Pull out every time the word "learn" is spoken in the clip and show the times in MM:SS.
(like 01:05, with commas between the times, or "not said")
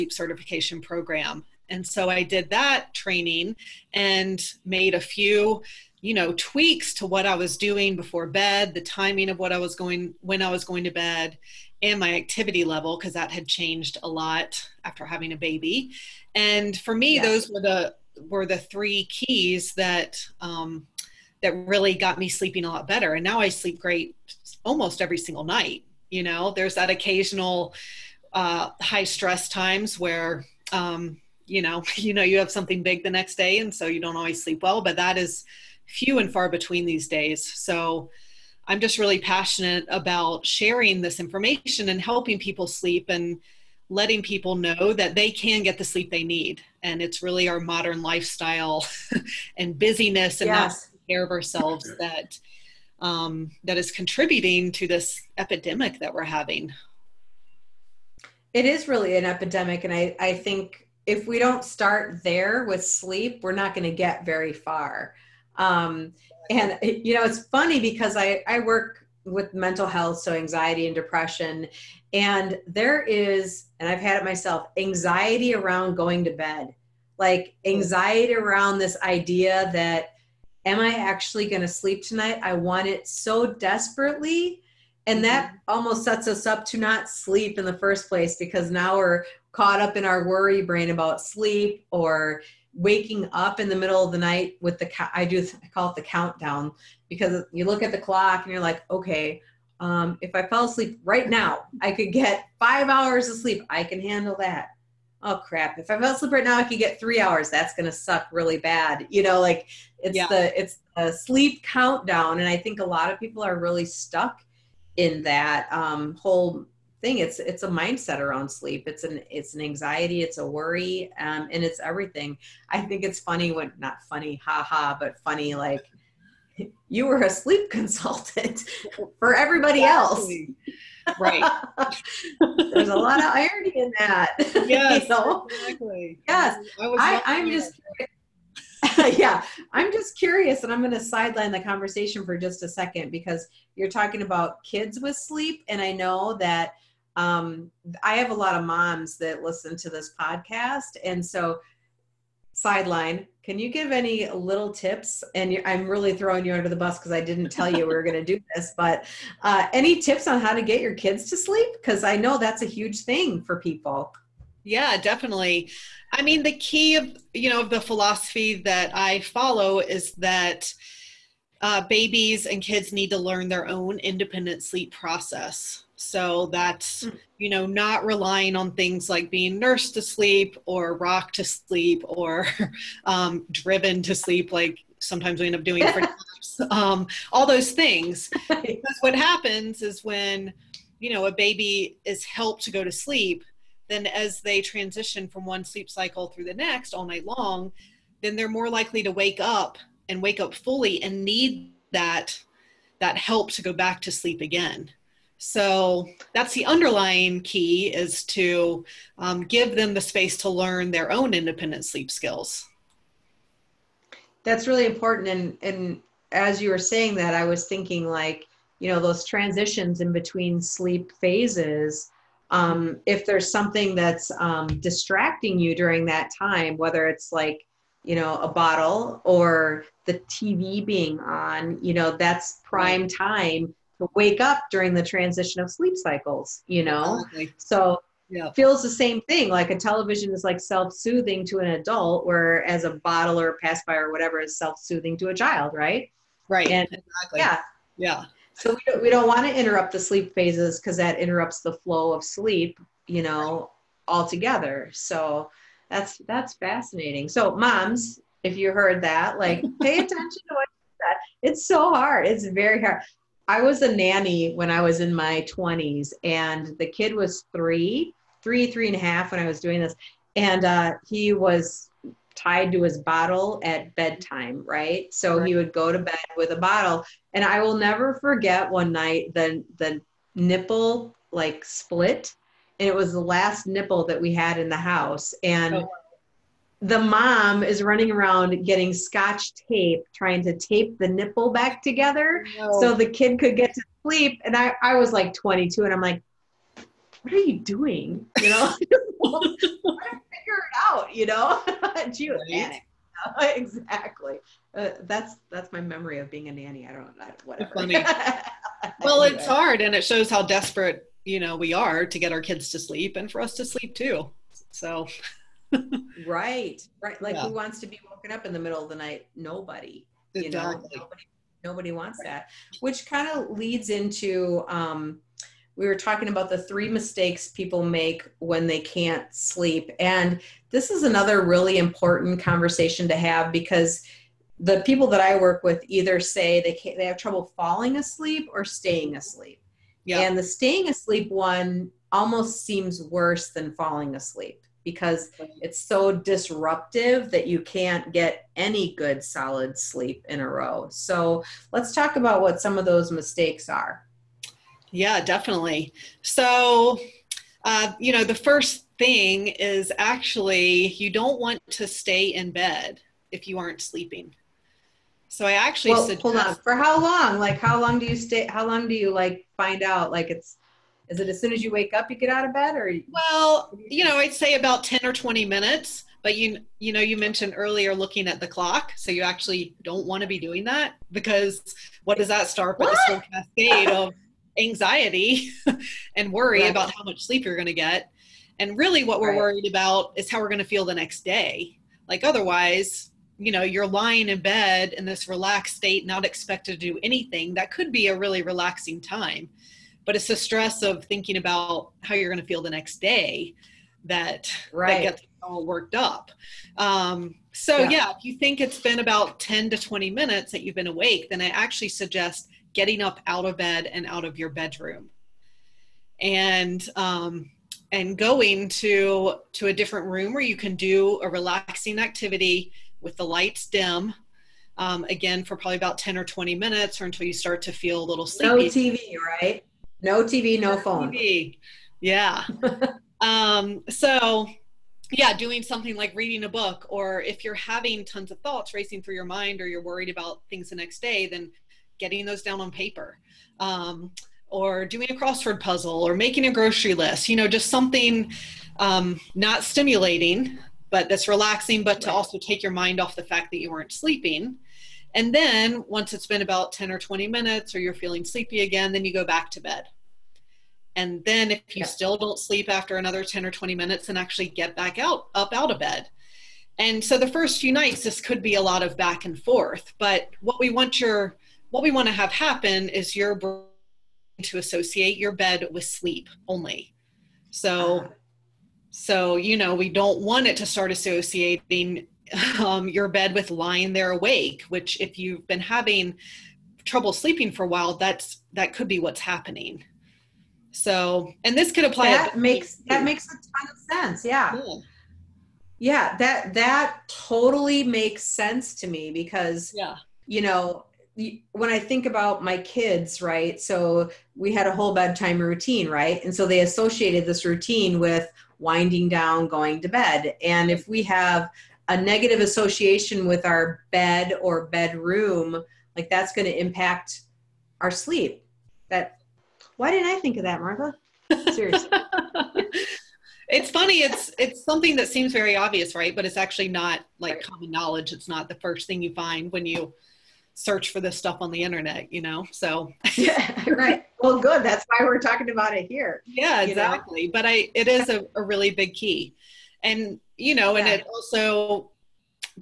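02:53, 03:30.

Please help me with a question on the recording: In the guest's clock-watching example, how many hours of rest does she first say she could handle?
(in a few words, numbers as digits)
5.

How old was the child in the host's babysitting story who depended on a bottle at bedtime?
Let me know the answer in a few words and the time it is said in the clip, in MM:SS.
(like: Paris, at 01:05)
3 and a half, at 04:28.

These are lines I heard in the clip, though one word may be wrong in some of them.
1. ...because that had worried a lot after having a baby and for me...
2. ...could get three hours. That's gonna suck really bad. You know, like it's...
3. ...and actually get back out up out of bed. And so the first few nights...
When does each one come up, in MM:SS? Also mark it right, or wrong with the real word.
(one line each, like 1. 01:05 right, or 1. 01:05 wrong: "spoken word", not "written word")
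1. 00:12 wrong: "changed", not "worried"
2. 01:46 right
3. 07:44 right.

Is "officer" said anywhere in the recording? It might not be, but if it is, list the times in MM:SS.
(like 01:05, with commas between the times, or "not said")
not said.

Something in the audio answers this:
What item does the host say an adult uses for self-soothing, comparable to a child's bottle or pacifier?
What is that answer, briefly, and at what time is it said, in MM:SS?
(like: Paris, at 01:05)
television, at 03:59.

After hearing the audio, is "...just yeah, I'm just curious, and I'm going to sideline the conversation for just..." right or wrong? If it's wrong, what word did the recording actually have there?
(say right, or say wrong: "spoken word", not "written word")
right.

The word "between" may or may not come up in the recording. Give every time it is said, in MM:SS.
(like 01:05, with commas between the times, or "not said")
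00:36, 03:40.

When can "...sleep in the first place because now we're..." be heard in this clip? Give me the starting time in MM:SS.
01:27.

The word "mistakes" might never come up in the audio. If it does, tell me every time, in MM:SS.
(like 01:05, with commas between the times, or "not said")
05:26, 05:53.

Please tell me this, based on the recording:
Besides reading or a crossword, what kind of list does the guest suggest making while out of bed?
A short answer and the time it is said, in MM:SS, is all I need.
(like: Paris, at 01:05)
grocery list, at 07:26.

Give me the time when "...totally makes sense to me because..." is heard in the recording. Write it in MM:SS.
08:17.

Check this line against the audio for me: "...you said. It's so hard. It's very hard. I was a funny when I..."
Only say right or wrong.
wrong.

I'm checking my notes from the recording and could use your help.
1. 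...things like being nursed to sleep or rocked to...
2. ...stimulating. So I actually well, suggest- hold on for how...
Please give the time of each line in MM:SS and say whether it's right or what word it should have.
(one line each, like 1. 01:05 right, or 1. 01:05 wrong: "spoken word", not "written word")
1. 02:58 right
2. 06:03 wrong: "sleeping", not "stimulating".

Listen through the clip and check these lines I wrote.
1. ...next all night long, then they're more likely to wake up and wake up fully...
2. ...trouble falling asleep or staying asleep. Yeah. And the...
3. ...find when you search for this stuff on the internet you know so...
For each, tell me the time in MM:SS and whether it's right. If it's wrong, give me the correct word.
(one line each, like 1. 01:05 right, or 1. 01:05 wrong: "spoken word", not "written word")
1. 03:16 right
2. 05:37 right
3. 08:49 right.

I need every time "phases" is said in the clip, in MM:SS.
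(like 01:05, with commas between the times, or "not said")
03:41, 04:10.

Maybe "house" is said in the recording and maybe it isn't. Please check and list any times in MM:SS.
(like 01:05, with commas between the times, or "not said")
04:44.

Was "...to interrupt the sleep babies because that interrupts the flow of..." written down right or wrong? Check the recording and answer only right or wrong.
wrong.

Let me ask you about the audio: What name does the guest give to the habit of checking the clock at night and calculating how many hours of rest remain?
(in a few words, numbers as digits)
the countdown.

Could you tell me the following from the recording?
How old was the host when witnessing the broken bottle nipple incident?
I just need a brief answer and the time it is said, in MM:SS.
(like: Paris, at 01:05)
22, at 04:55.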